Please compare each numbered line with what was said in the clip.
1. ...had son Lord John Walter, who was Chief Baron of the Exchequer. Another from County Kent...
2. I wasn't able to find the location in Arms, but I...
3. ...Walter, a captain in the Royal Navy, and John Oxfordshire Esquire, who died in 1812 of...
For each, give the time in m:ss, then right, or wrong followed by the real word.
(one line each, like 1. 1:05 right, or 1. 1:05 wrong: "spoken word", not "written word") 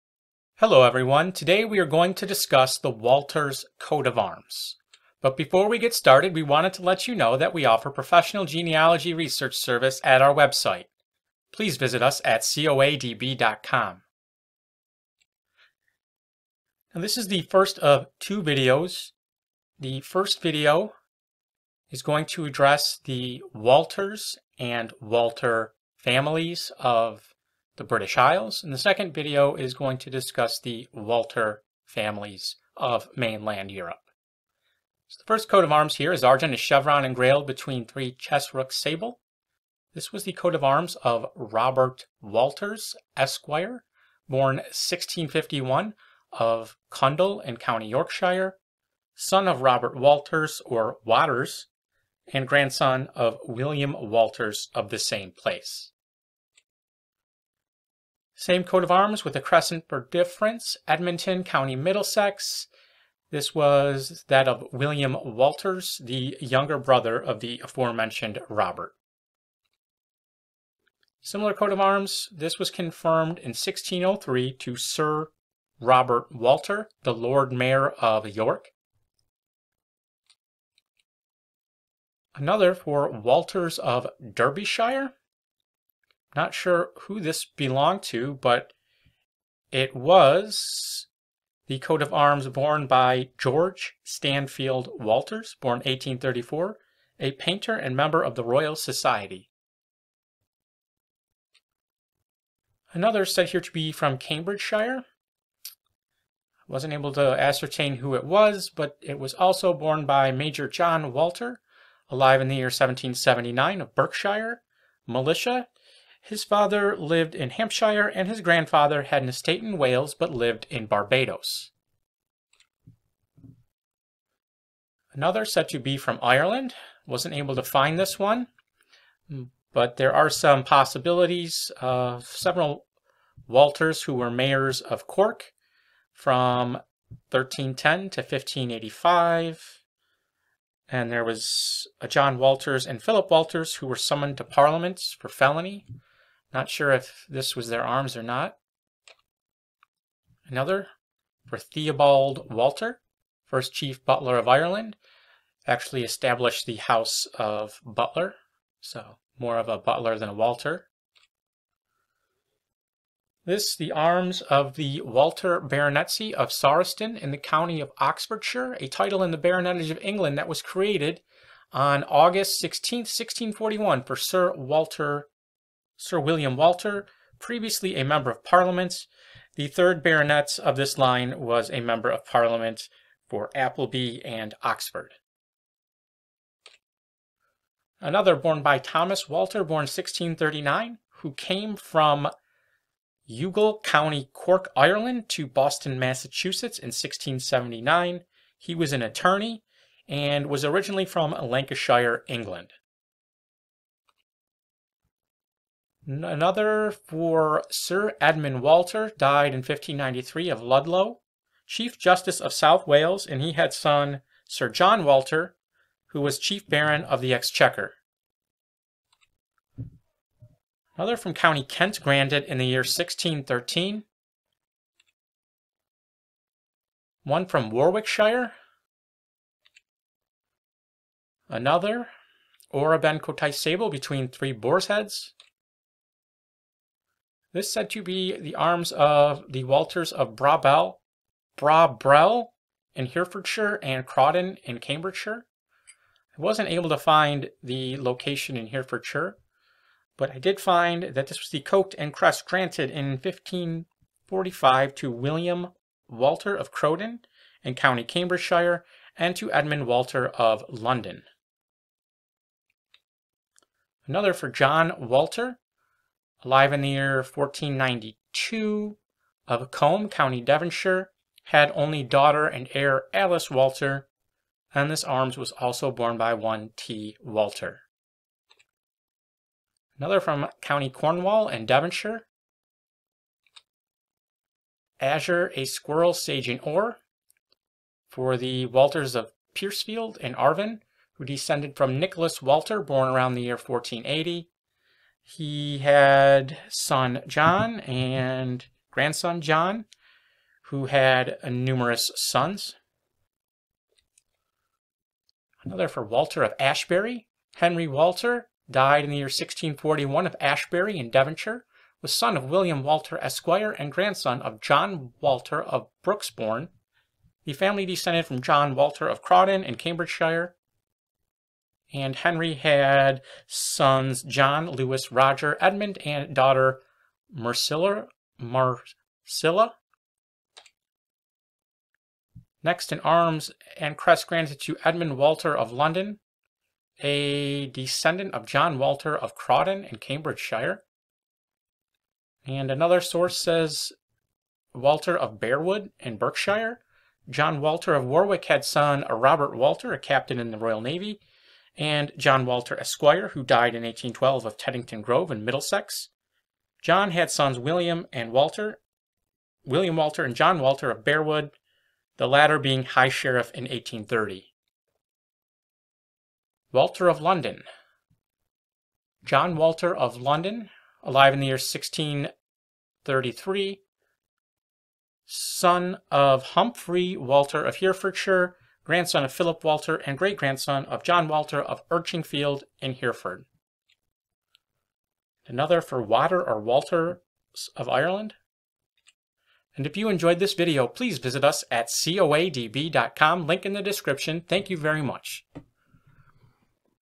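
1. 3:33 wrong: "Sir", not "Lord"
2. 4:06 wrong: "Herefordshire", not "Arms"
3. 5:49 wrong: "Walter", not "Oxfordshire".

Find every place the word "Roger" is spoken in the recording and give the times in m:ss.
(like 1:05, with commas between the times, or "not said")
5:25.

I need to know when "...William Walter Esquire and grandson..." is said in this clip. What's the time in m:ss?
5:12.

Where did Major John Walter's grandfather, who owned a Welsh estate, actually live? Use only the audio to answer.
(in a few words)
Barbados.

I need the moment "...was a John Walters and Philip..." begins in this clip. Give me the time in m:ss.
2:21.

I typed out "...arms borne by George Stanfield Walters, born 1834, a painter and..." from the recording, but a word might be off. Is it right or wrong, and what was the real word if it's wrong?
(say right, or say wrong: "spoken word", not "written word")
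right.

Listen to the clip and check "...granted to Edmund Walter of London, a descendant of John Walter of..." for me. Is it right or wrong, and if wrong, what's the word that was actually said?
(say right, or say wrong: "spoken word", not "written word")
right.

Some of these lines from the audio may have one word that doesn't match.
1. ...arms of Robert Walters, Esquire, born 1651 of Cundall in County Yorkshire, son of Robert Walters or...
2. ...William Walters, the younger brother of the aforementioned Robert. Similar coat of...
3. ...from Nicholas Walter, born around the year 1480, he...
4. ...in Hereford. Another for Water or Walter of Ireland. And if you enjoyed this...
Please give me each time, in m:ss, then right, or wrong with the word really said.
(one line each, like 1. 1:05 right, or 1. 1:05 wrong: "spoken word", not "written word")
1. 0:40 right
2. 1:04 right
3. 4:51 right
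4. 6:22 right.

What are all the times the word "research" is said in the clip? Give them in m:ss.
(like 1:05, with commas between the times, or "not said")
0:09.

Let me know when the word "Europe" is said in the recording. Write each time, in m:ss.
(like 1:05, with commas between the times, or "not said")
0:33.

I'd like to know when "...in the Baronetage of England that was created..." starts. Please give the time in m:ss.
2:49.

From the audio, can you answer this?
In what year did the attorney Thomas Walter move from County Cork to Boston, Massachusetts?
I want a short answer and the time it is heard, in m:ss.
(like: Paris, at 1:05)
1679, at 3:16.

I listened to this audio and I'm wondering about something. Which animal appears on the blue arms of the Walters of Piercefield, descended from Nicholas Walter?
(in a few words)
A squirrel.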